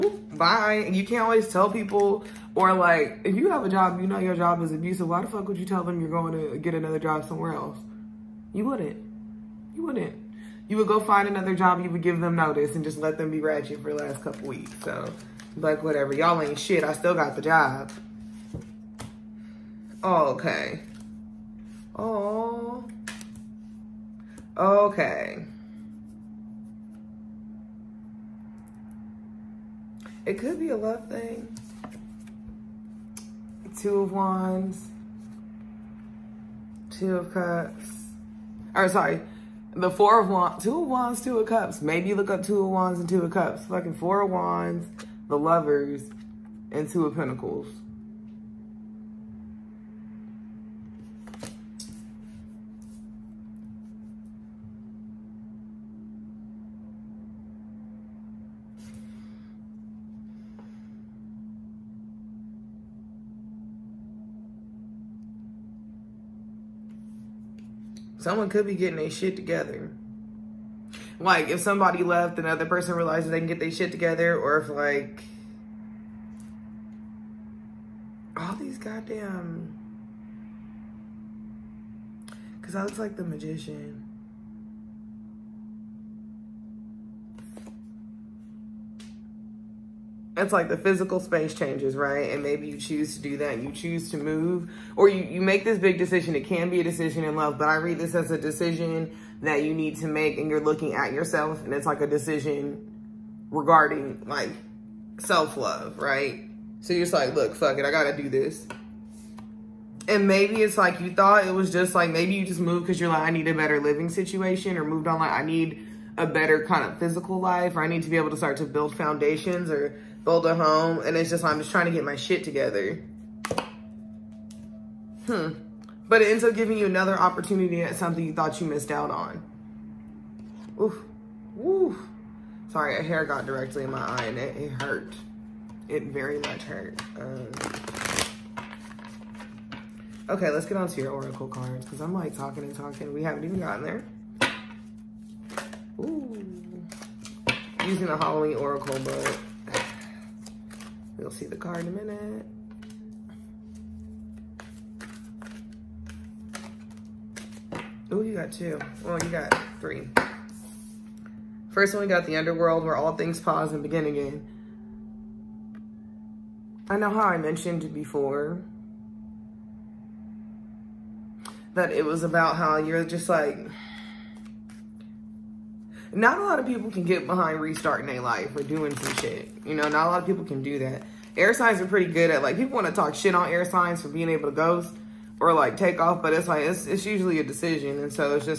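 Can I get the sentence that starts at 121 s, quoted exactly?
And it's just, I'm just trying to get my shit together.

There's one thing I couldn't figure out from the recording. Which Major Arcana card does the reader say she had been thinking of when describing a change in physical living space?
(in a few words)
The Magician.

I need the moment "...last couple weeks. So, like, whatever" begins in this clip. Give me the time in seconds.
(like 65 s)
14 s.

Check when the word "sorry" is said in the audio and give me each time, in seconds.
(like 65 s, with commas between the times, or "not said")
38 s, 132 s.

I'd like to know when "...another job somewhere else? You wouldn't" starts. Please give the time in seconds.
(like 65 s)
6 s.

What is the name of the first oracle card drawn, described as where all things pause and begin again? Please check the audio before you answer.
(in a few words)
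The Underworld.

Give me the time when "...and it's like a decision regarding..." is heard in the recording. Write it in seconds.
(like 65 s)
101 s.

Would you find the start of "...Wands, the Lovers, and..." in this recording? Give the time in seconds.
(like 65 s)
44 s.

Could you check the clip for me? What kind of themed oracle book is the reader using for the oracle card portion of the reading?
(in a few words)
Halloween.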